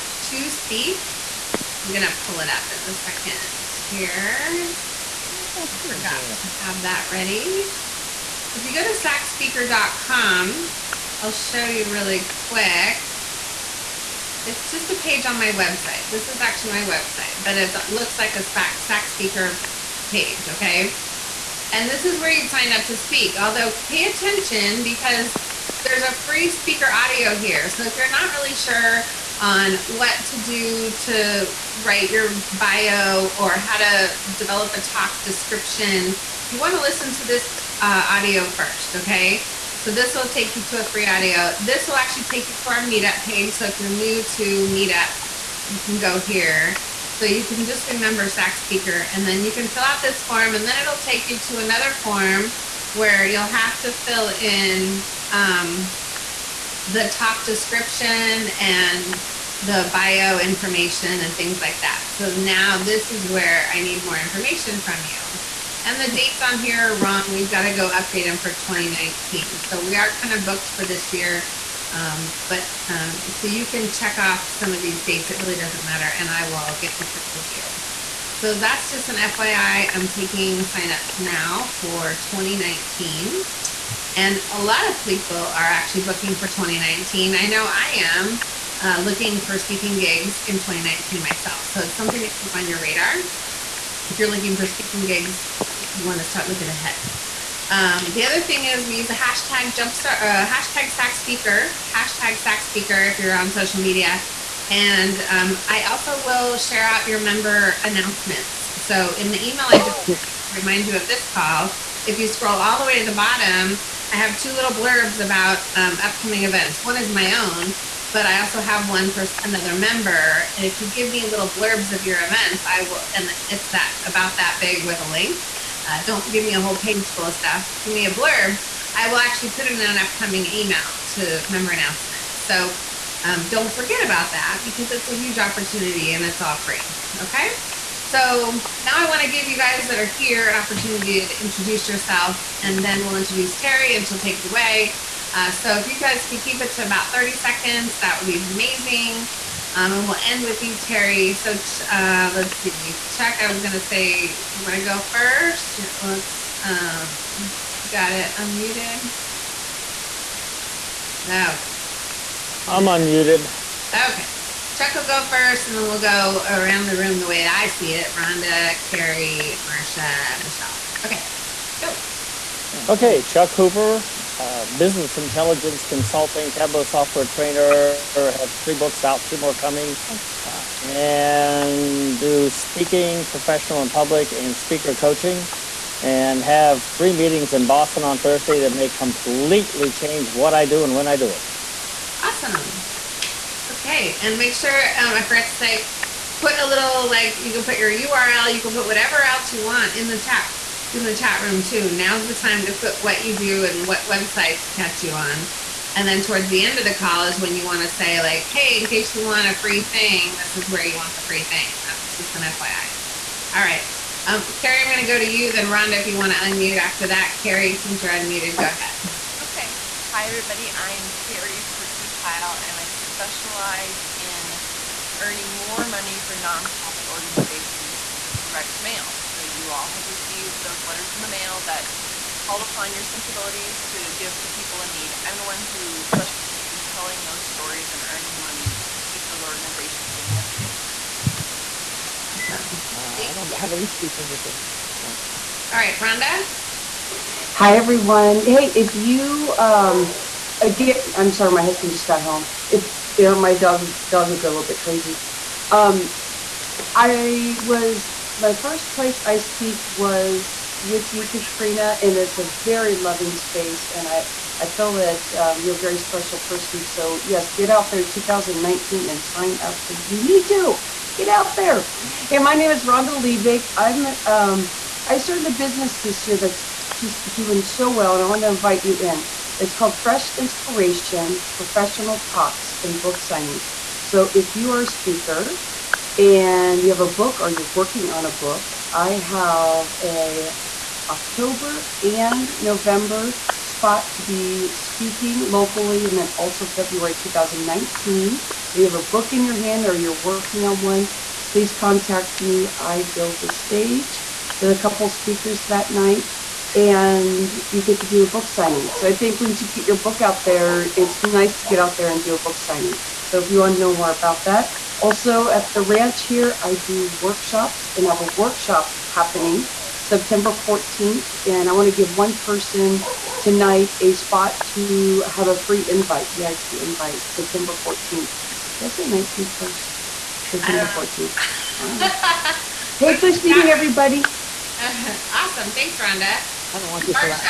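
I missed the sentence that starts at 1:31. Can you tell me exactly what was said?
So it's something to keep on your radar.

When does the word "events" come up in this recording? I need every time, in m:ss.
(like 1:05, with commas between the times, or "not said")
1:56, 2:02.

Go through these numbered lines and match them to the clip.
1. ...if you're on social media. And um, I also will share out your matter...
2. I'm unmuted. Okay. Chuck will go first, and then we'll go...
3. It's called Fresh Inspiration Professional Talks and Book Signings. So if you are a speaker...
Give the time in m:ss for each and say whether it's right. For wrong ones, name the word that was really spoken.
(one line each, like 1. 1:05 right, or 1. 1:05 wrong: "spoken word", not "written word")
1. 1:43 wrong: "member", not "matter"
2. 2:42 right
3. 4:39 right.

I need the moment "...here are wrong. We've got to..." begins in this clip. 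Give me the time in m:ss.
1:06.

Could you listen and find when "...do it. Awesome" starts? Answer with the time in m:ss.
3:11.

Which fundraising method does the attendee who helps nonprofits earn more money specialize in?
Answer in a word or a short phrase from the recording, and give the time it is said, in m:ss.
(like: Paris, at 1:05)
direct mail, at 3:48.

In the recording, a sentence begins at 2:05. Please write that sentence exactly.
Uh, don't give me a whole page full of stuff.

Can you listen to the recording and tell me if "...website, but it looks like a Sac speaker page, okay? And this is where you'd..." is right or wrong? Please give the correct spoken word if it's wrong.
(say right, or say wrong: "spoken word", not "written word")
right.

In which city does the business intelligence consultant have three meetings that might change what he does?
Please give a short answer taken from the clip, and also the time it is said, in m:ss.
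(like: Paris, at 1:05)
Boston, at 3:07.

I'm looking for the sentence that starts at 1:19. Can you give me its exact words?
I'm taking signups now for 2019.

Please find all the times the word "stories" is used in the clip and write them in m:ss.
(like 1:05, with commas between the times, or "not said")
3:57.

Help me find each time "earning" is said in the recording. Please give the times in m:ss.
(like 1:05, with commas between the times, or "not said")
3:45, 3:58.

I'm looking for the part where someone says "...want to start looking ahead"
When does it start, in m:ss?
1:36.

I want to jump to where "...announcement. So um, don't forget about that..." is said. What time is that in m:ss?
2:11.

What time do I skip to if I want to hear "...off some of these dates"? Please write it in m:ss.
1:14.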